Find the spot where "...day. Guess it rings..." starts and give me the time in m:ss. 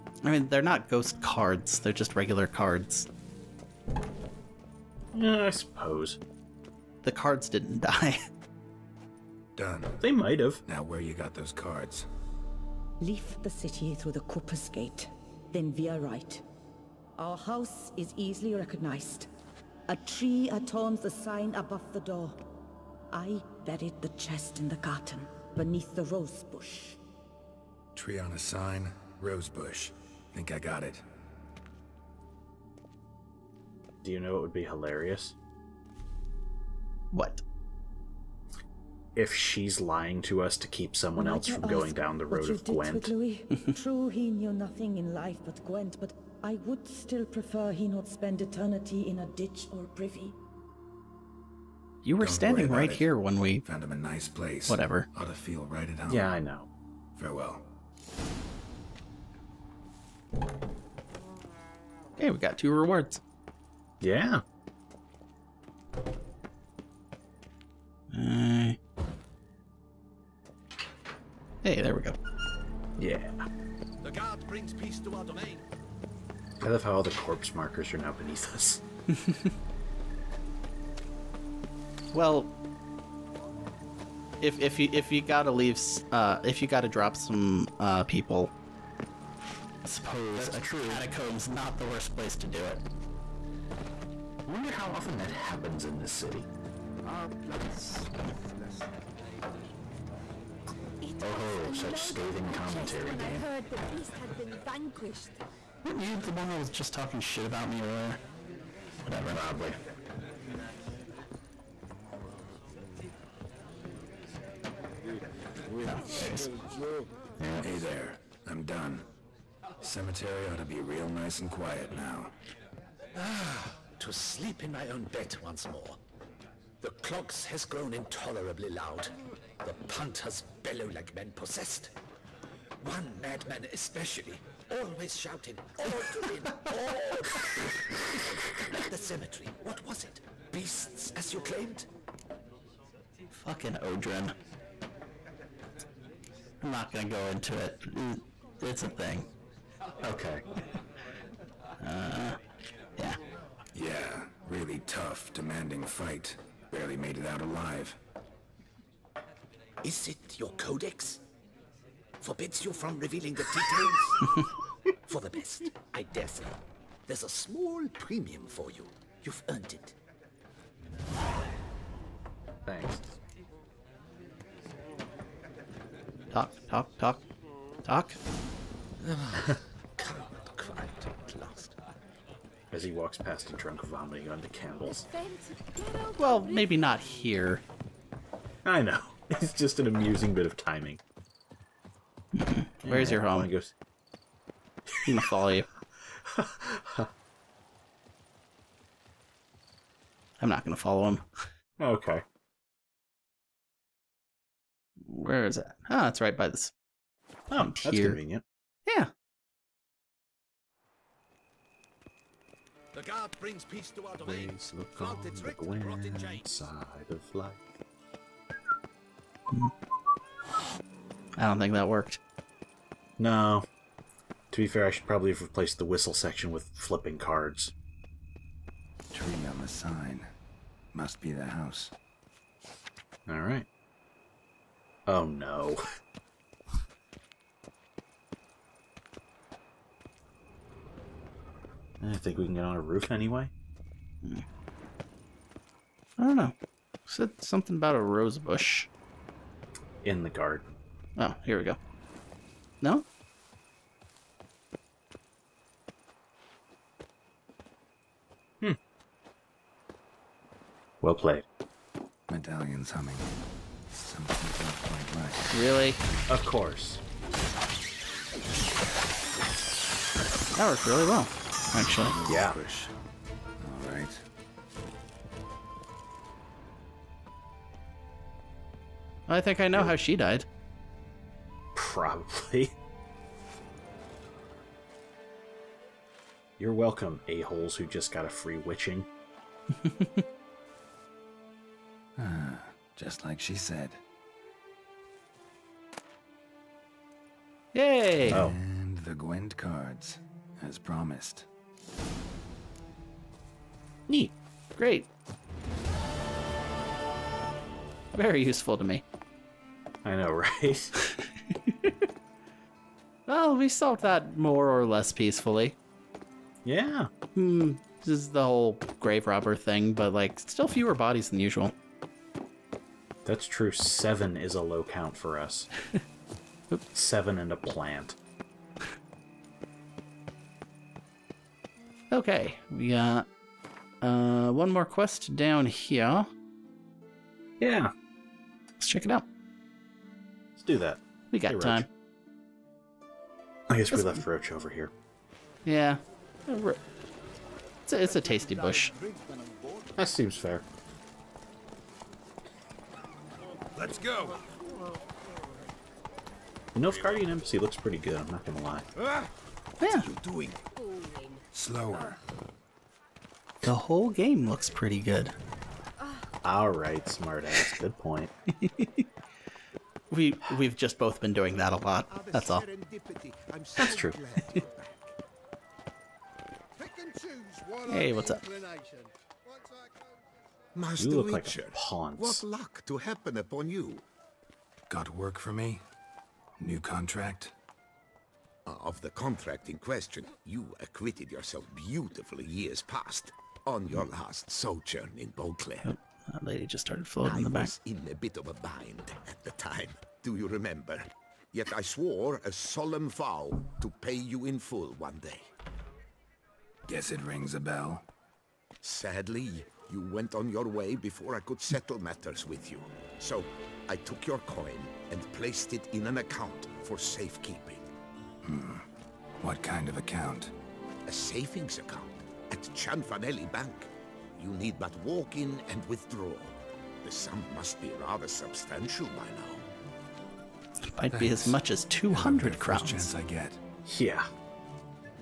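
6:45.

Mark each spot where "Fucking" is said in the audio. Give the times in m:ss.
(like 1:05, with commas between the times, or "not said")
2:23.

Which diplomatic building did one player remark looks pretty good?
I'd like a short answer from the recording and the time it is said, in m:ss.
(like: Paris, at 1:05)
Nilfgaardian Embassy, at 5:56.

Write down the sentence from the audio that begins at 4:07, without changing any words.
Said something about a rose bush in the garden.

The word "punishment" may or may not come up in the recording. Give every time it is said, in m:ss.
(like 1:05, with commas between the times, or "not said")
not said.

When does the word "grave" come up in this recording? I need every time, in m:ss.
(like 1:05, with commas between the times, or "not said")
5:19.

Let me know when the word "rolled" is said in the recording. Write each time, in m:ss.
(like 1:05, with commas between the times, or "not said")
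not said.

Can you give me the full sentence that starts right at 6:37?
was in a bit of a bind at the time, do you remember?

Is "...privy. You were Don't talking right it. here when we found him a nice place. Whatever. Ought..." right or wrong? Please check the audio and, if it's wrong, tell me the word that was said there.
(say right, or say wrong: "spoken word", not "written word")
wrong: "standing", not "talking".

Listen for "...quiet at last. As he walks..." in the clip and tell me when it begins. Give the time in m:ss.
2:59.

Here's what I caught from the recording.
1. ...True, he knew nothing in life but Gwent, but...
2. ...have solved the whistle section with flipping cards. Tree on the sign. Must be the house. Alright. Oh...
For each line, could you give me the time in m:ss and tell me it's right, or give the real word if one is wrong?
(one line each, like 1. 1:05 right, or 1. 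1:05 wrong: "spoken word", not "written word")
1. 0:43 right
2. 3:45 wrong: "replaced", not "solved".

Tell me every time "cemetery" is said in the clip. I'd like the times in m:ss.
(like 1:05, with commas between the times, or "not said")
1:59, 2:18.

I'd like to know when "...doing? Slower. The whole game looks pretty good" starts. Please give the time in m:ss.
6:00.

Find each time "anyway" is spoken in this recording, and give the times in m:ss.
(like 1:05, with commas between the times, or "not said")
4:03.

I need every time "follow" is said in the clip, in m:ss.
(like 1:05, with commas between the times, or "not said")
3:15, 3:20.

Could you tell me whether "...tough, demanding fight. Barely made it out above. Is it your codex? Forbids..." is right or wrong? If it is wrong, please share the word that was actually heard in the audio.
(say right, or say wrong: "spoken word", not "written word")
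wrong: "alive", not "above".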